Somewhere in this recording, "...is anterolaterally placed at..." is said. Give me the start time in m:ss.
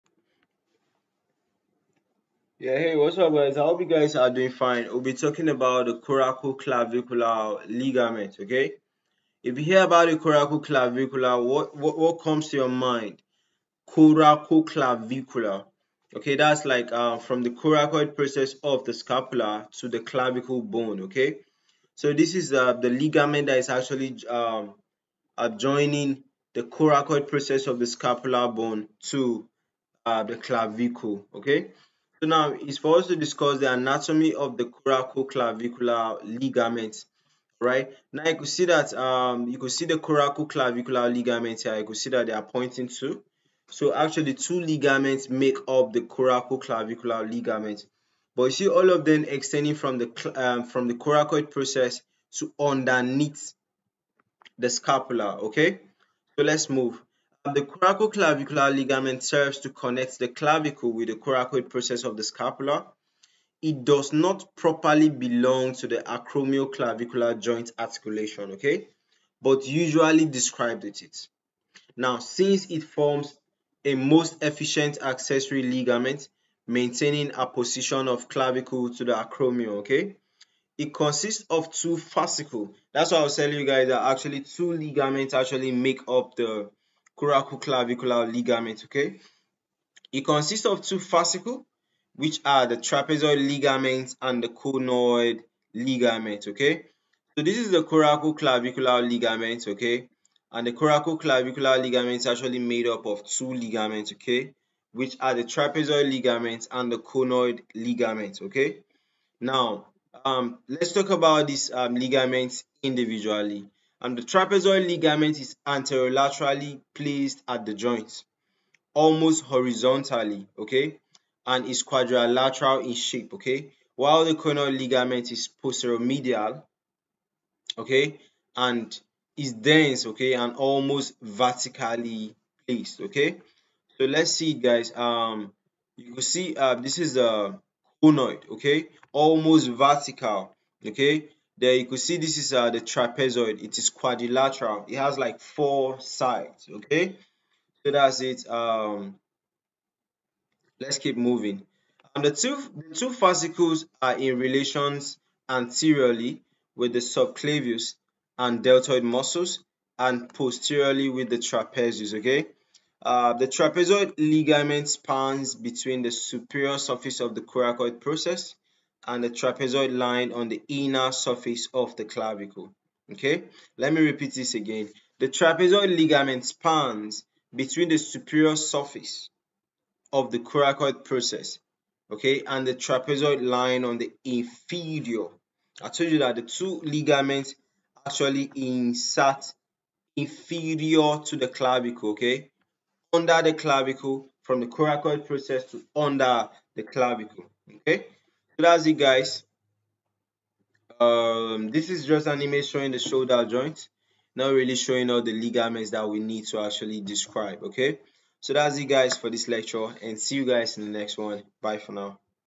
1:55.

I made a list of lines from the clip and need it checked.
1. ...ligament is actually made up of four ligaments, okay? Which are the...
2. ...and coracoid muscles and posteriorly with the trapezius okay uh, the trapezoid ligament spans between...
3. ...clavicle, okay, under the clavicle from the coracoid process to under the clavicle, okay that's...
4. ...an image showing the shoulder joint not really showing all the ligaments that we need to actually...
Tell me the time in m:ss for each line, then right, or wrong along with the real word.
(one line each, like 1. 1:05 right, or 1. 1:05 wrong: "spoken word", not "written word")
1. 1:41 wrong: "two", not "four"
2. 2:38 wrong: "deltoid", not "coracoid"
3. 3:11 right
4. 3:22 right.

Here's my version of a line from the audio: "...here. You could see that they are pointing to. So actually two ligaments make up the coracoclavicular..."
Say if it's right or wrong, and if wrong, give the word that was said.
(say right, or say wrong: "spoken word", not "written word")
right.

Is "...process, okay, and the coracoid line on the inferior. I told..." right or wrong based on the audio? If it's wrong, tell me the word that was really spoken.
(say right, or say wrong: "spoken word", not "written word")
wrong: "trapezoid", not "coracoid".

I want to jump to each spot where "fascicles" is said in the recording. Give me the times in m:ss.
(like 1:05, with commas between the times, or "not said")
1:21, 1:30, 2:33.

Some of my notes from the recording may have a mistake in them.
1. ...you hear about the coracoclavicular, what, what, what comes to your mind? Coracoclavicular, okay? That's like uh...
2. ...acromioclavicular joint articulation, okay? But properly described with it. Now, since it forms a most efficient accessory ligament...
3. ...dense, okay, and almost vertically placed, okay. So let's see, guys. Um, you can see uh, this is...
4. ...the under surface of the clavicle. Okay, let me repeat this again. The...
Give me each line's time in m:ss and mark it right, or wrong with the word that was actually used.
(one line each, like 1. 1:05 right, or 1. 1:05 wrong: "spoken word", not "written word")
1. 0:09 right
2. 1:05 wrong: "usually", not "properly"
3. 2:09 right
4. 2:50 wrong: "inner", not "under".